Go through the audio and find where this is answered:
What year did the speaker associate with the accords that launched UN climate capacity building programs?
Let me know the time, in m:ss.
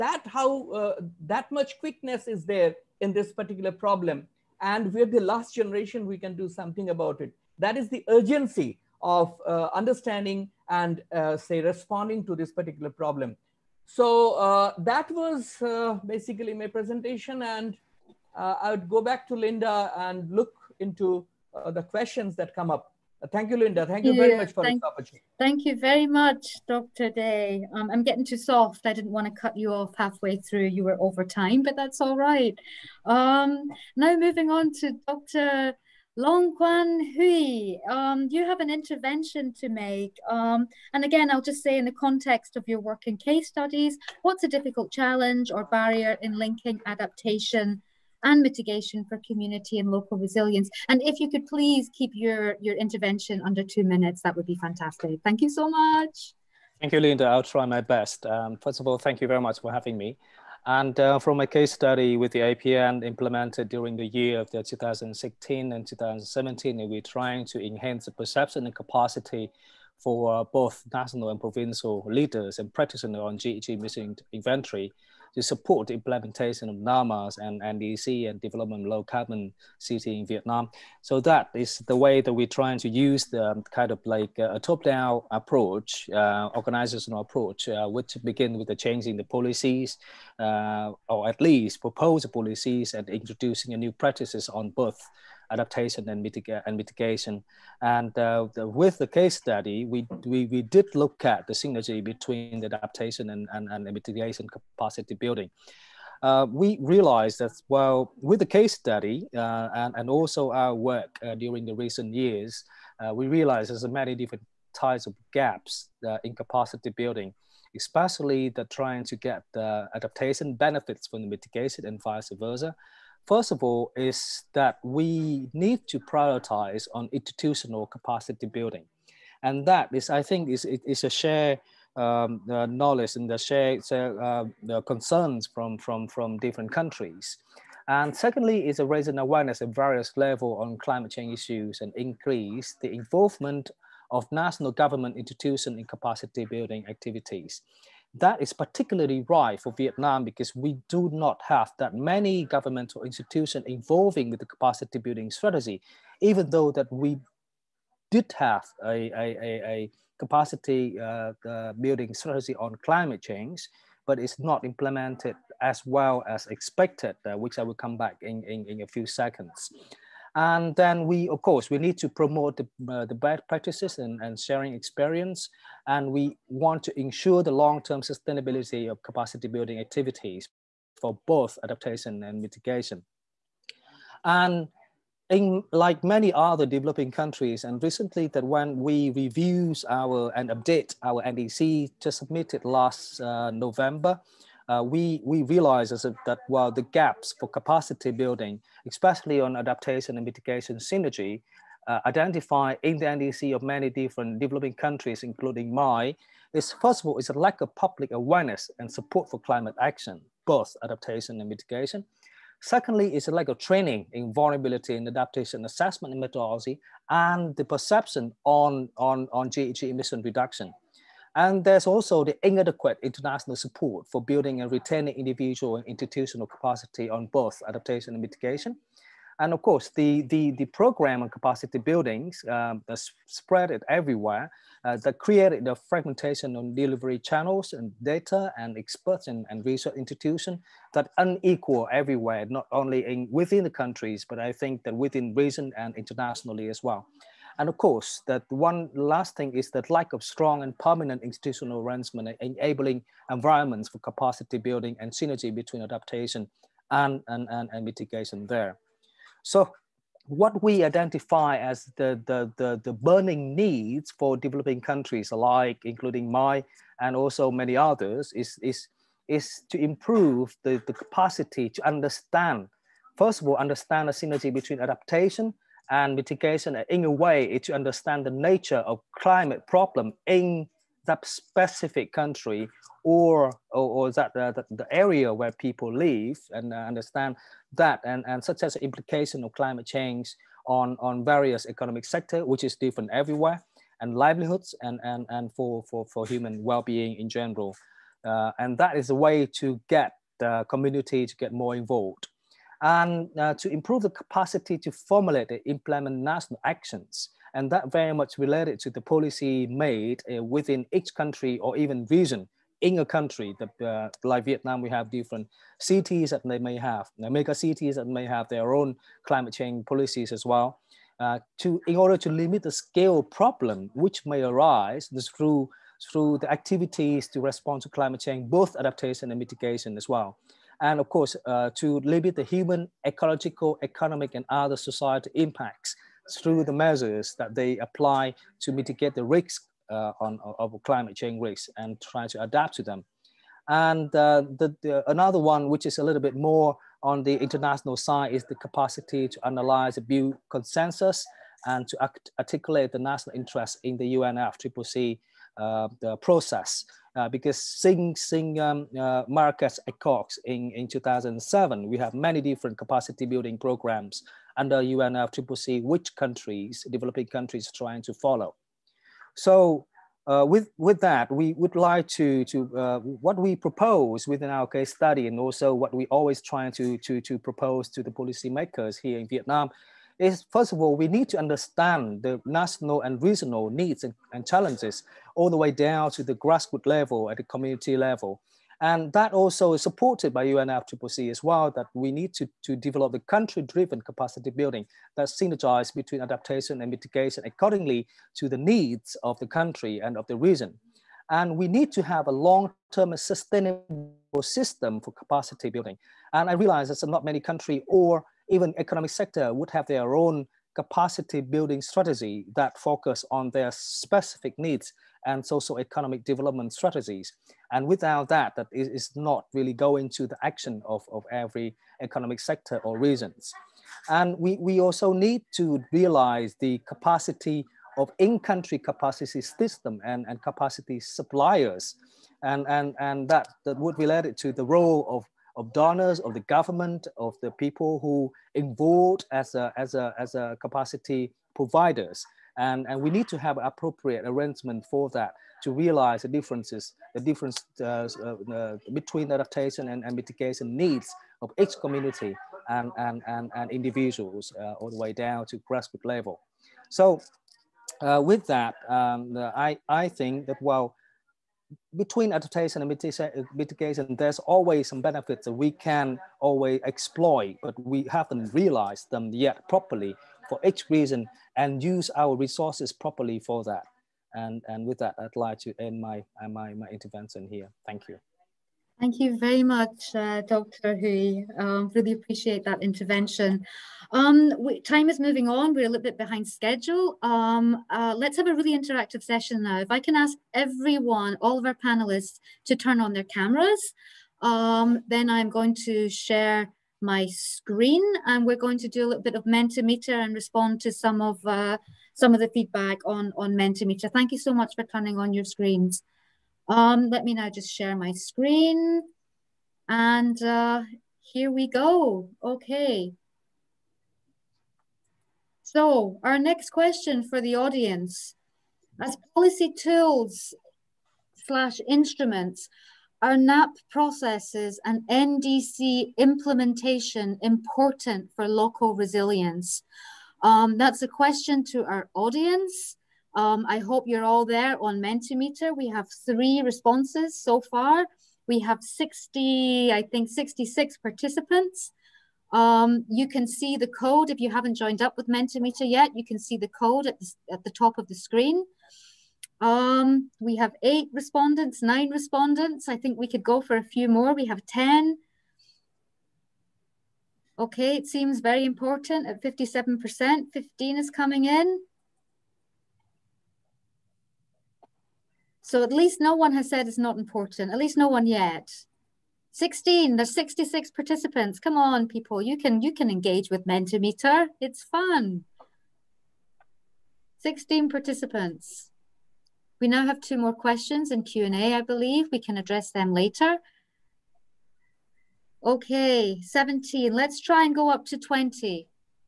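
6:00.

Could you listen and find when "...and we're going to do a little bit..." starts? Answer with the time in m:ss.
8:18.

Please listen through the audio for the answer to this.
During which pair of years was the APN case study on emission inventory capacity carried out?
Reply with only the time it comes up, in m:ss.
1:04.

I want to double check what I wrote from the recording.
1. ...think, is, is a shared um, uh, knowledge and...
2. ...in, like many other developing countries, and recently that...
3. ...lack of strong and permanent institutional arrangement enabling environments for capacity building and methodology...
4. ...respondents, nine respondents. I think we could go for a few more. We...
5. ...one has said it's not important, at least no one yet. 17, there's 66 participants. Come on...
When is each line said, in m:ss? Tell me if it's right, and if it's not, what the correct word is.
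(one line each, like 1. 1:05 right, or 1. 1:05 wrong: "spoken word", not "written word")
1. 2:10 right
2. 3:05 right
3. 4:09 wrong: "synergy", not "methodology"
4. 9:11 right
5. 9:26 wrong: "16", not "17".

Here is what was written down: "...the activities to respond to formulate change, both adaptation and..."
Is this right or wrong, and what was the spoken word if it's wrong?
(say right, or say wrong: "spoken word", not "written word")
wrong: "climate", not "formulate".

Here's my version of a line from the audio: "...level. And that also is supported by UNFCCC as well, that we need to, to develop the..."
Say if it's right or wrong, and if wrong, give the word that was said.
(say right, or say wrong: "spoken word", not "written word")
right.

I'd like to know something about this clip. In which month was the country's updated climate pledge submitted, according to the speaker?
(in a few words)
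November.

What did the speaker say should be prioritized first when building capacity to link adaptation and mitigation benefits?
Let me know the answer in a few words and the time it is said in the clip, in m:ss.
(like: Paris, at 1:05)
institutional capacity building, at 2:07.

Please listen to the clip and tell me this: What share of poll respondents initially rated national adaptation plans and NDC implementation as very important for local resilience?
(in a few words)
57%.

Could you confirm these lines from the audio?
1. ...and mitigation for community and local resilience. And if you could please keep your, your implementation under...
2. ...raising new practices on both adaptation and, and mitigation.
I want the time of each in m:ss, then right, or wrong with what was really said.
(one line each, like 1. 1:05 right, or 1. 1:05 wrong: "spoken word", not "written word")
1. 0:48 wrong: "intervention", not "implementation"
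2. 1:33 wrong: "introducing", not "raising".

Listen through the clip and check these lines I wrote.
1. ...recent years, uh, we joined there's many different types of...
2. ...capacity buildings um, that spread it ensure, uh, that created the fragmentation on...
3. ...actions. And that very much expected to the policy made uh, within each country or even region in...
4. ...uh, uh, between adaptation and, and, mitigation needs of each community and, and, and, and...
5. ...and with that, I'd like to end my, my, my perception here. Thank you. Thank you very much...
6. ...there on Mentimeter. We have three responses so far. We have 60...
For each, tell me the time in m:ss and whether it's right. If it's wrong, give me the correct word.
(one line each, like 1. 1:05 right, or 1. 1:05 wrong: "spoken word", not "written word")
1. 1:51 wrong: "realized", not "joined"
2. 3:51 wrong: "everywhere", not "ensure"
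3. 5:06 wrong: "related", not "expected"
4. 7:27 right
5. 7:54 wrong: "intervention", not "perception"
6. 8:54 right.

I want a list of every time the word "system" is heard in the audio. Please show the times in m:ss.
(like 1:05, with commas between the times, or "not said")
6:44, 7:09.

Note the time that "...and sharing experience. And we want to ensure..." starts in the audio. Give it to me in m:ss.
2:54.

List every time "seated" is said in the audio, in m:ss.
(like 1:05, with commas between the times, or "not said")
not said.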